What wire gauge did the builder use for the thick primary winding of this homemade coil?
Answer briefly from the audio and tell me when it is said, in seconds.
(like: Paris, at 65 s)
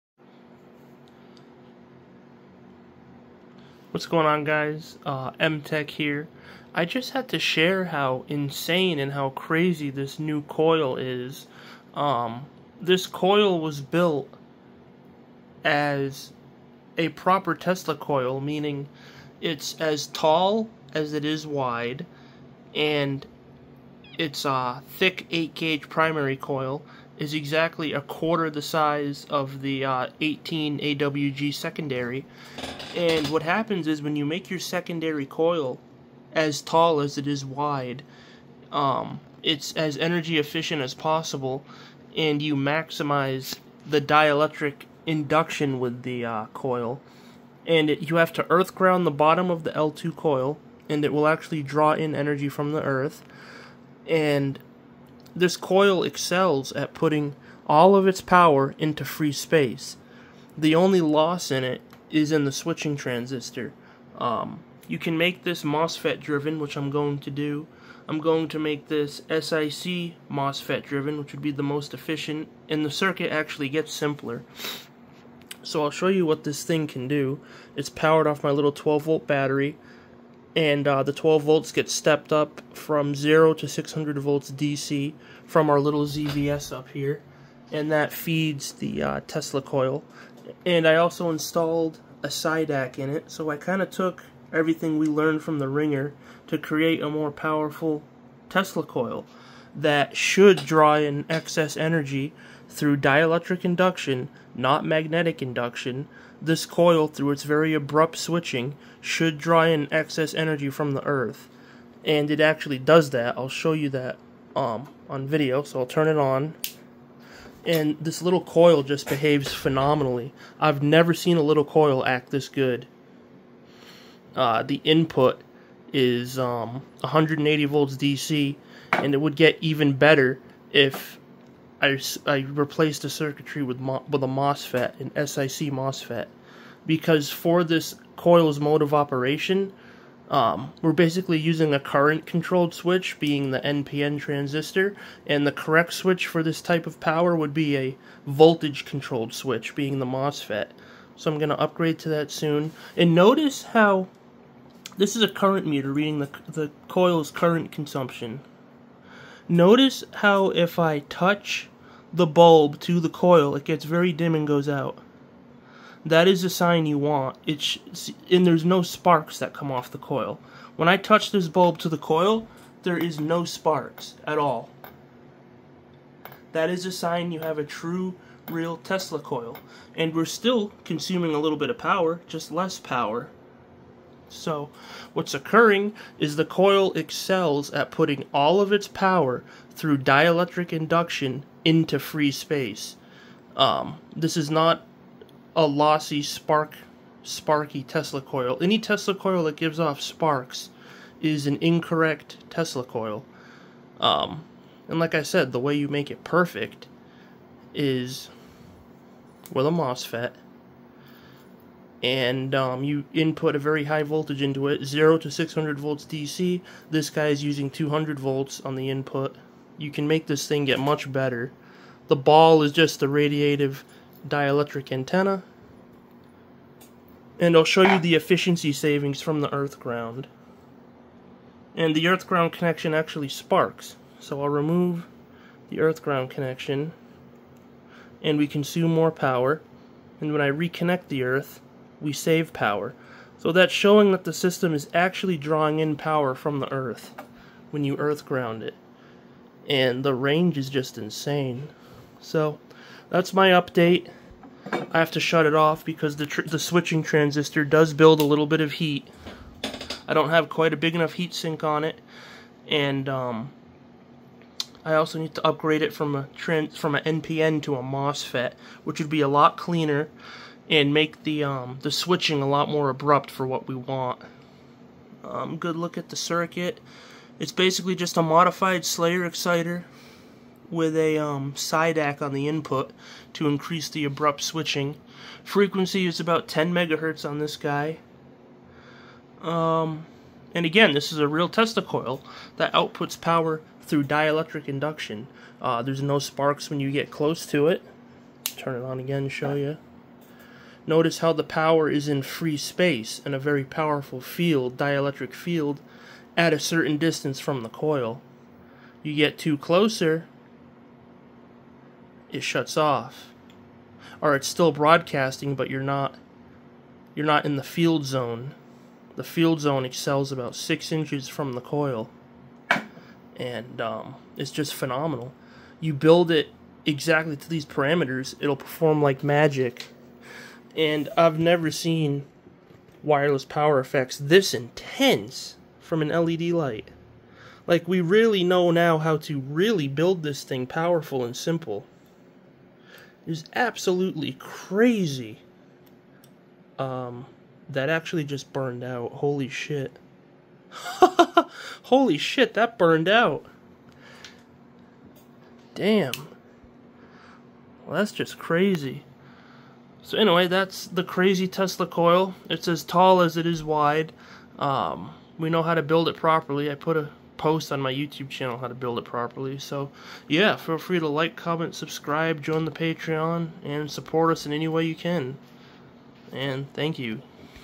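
8 gauge, at 25 s.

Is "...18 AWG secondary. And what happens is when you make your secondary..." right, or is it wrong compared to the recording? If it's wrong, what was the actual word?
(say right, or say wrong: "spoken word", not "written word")
right.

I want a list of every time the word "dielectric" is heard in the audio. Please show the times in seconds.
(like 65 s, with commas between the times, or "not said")
44 s, 102 s, 189 s, 224 s, 294 s, 304 s.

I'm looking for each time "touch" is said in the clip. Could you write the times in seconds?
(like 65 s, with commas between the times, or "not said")
160 s, 170 s.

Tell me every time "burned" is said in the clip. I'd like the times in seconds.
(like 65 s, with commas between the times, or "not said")
348 s, 352 s.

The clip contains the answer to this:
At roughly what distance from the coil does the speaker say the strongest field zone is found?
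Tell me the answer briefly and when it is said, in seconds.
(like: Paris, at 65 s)
6 inches, at 320 s.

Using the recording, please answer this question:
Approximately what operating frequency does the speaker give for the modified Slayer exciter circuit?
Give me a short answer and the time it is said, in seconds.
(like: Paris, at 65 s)
10 megahertz, at 286 s.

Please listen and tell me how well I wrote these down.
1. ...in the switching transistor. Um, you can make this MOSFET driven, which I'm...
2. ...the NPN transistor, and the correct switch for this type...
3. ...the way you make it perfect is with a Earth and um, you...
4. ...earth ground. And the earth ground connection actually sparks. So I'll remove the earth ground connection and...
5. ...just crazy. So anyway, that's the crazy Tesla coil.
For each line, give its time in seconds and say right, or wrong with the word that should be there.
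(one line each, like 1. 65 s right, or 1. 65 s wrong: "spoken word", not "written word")
1. 62 s right
2. 143 s right
3. 205 s wrong: "MOSFET", not "Earth"
4. 229 s right
5. 358 s right.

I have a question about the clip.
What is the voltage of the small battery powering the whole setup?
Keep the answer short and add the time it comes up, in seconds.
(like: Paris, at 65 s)
12 volts, at 78 s.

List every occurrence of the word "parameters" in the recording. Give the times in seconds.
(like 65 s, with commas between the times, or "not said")
327 s.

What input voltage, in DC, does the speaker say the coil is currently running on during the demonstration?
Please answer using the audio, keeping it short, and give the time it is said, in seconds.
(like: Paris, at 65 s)
180 volts, at 127 s.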